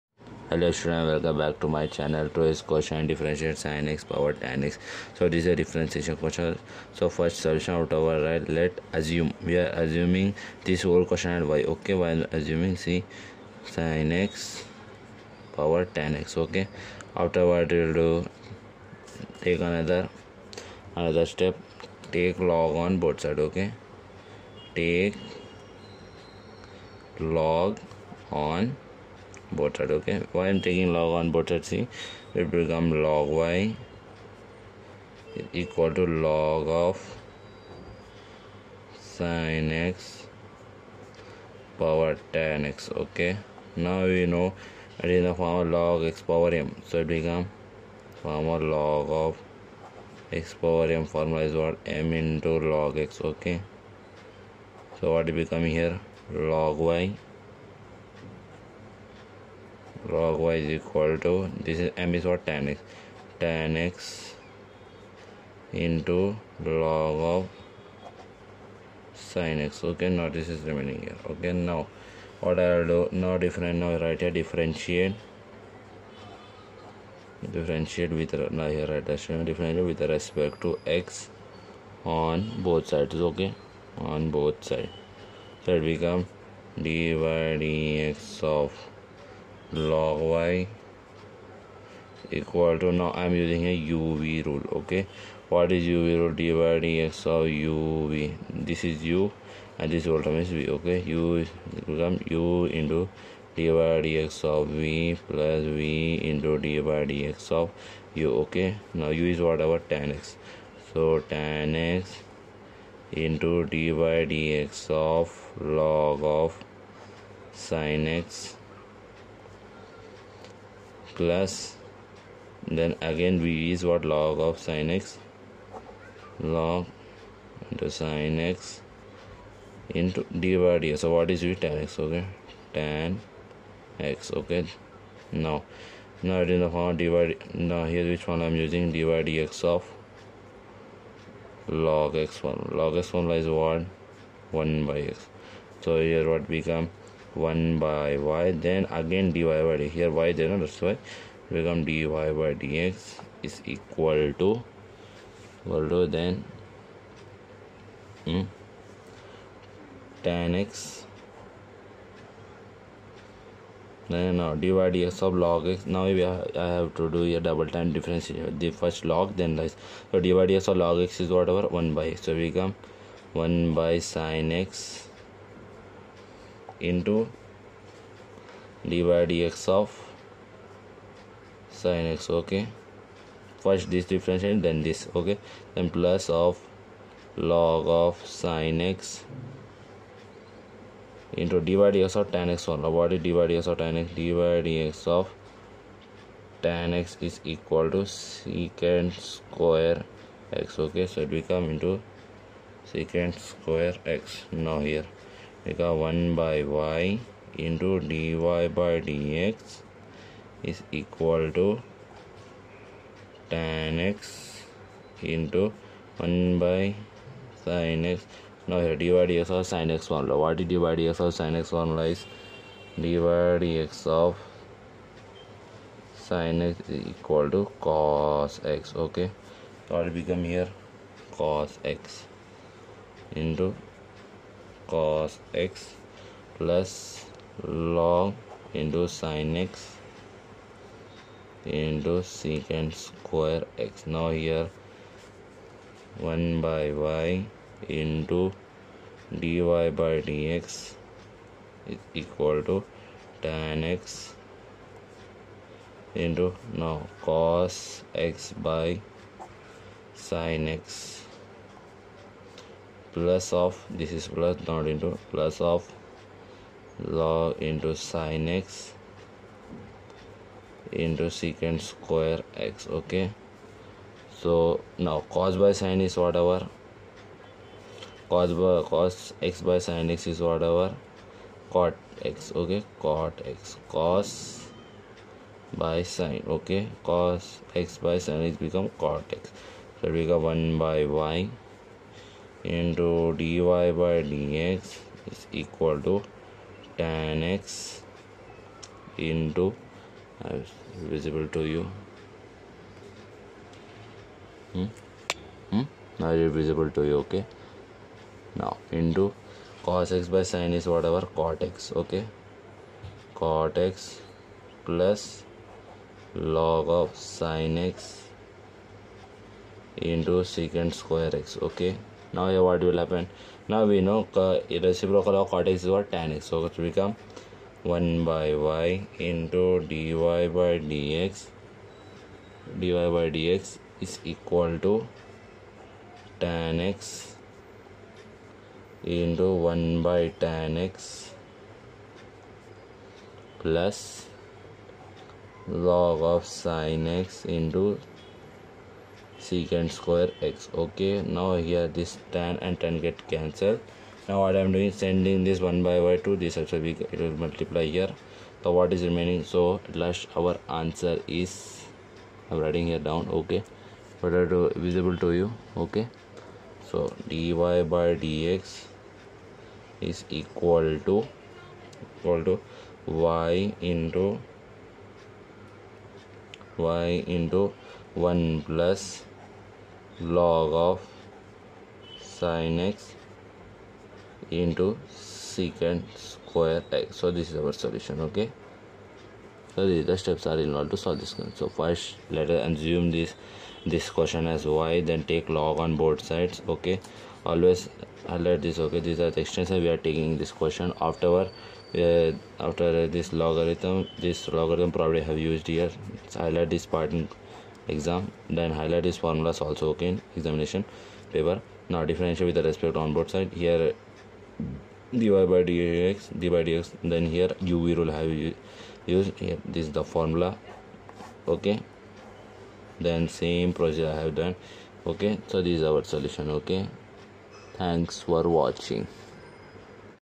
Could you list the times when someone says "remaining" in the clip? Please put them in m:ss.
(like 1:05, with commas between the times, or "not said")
1:10, 5:59.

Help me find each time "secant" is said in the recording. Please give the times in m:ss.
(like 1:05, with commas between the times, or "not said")
3:18, 3:22, 4:02, 4:31, 5:20, 5:49, 6:25.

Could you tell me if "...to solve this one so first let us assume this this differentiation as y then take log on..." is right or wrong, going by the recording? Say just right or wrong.
wrong.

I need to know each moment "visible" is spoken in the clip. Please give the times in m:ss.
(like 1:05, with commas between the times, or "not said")
5:00, 5:06, 6:04.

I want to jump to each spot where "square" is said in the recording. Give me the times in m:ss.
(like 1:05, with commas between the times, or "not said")
3:19, 3:23, 4:03, 4:31, 5:20, 5:49, 6:26.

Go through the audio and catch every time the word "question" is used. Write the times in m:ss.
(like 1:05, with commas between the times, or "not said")
6:34, 6:40.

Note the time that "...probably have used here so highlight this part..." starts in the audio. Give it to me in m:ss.
6:44.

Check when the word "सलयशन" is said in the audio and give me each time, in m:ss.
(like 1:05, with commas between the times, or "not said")
0:07.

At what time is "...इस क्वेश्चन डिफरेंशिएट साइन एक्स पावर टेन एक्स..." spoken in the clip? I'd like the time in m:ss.
0:02.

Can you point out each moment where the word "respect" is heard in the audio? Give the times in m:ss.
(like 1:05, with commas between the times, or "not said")
1:20, 6:52.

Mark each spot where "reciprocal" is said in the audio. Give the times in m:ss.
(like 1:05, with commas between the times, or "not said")
5:24.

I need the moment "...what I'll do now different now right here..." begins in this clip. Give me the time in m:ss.
1:12.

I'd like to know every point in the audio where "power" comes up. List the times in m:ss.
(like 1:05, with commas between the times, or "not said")
0:41, 0:46, 0:50.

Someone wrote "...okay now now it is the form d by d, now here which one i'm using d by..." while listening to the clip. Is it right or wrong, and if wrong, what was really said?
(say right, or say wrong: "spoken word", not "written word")
right.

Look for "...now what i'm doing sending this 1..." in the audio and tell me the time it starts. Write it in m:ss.
5:54.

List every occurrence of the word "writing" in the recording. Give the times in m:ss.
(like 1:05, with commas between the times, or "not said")
6:02.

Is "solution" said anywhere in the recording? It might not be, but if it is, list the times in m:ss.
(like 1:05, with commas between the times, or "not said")
6:27, 7:06.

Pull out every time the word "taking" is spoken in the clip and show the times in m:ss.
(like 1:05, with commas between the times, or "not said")
0:30, 6:40.